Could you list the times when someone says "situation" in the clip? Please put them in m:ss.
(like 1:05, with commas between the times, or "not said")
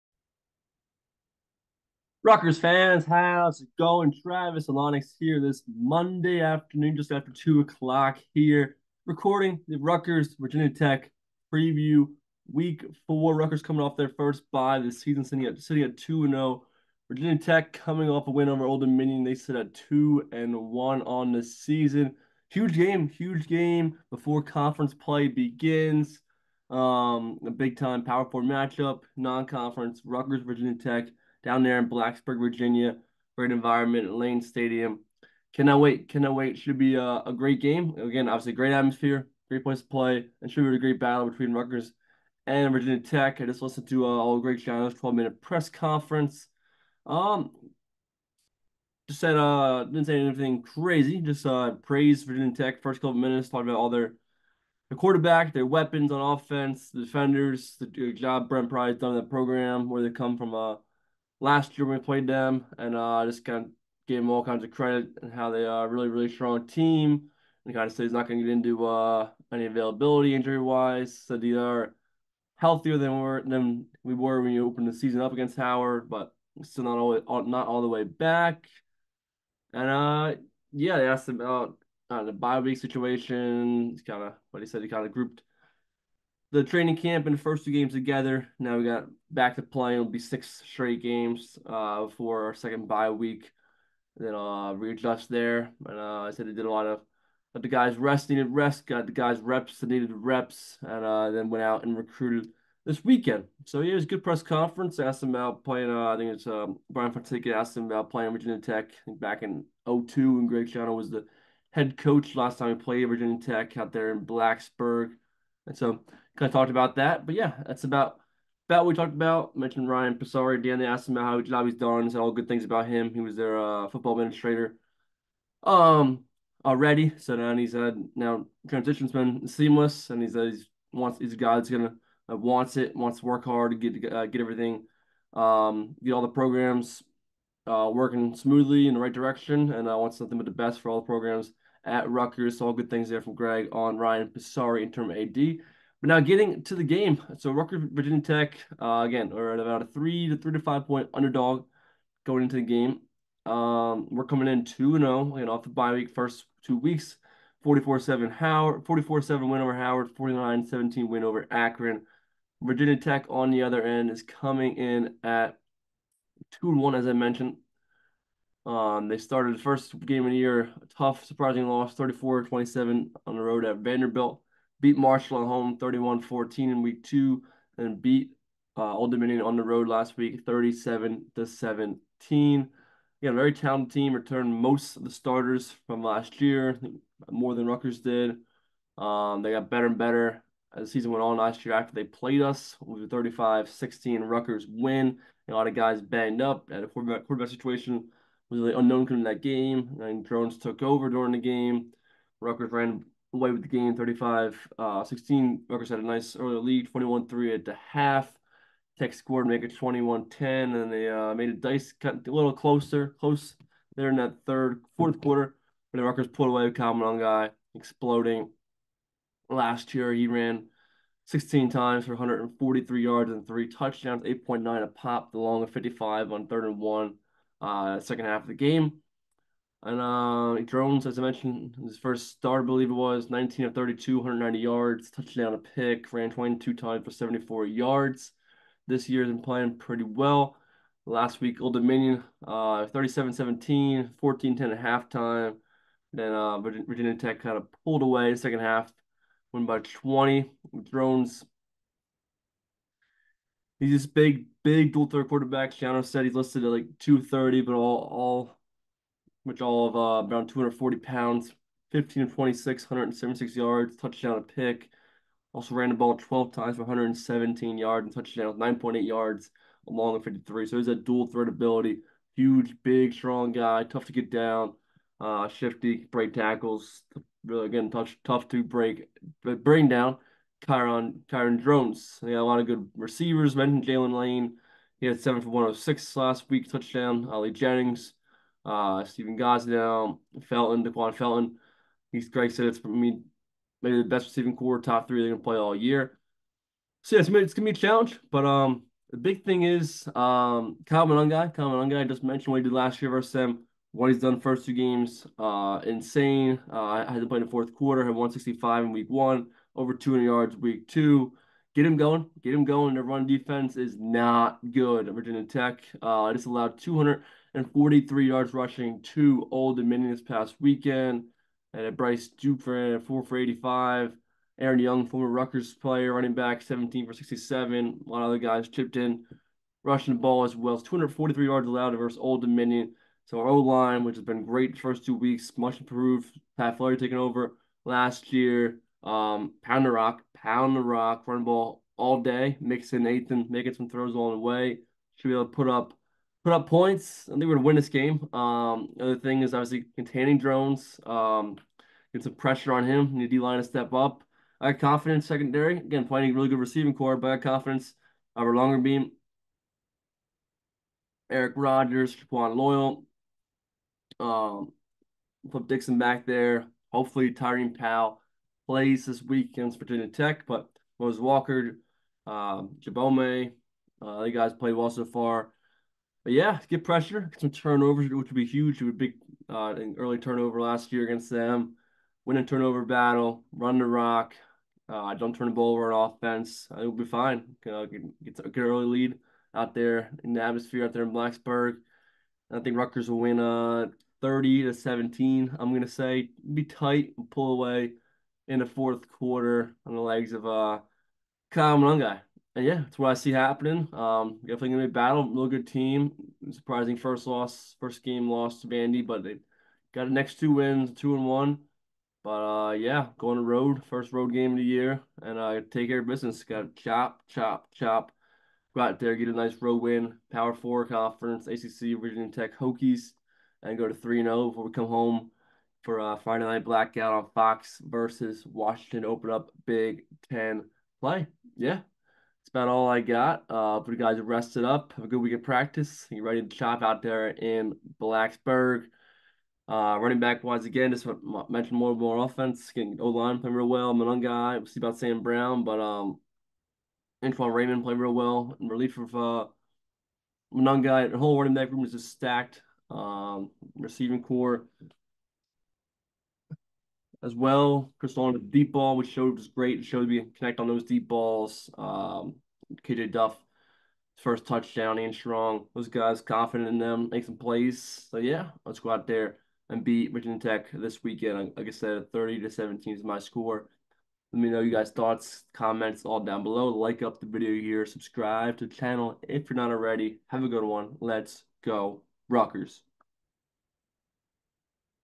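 1:22, 3:17.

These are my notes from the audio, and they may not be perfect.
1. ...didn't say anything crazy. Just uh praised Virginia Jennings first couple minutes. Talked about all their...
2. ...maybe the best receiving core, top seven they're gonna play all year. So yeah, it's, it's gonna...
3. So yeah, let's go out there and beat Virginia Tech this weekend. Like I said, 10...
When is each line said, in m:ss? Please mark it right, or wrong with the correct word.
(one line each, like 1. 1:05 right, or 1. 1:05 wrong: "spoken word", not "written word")
1. 0:49 wrong: "Tech", not "Jennings"
2. 4:53 wrong: "three", not "seven"
3. 7:48 wrong: "30", not "10".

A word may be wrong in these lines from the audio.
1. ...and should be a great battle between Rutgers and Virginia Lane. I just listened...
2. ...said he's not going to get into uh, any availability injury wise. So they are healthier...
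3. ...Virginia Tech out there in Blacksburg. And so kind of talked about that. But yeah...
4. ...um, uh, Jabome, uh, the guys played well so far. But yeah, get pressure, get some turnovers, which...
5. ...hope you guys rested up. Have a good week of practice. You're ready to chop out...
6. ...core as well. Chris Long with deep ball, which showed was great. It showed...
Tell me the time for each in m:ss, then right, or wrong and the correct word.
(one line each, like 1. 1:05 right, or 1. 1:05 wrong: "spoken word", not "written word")
1. 0:40 wrong: "Tech", not "Lane"
2. 1:07 right
3. 1:53 right
4. 6:12 right
5. 7:13 right
6. 7:34 right.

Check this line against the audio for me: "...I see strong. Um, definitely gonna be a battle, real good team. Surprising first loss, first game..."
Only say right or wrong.
wrong.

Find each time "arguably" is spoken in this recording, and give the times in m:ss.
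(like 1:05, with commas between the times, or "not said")
not said.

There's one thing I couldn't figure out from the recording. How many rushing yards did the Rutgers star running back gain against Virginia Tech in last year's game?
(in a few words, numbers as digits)
143.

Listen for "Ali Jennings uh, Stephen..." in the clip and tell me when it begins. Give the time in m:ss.
4:47.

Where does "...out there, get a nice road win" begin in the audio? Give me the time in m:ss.
6:58.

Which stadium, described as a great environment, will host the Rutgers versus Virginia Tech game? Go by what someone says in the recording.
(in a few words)
Lane Stadium.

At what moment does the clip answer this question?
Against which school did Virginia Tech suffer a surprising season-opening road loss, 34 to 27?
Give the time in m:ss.
2:53.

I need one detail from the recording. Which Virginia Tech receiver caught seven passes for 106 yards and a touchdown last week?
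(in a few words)
Jaylin Lane.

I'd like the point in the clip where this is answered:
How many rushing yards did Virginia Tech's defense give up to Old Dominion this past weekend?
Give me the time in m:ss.
5:30.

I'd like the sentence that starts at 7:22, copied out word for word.
Getting O line playing real well.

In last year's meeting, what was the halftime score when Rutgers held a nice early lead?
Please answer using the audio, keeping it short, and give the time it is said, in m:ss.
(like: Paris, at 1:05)
21-3, at 3:26.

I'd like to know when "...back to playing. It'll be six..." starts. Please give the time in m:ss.
1:29.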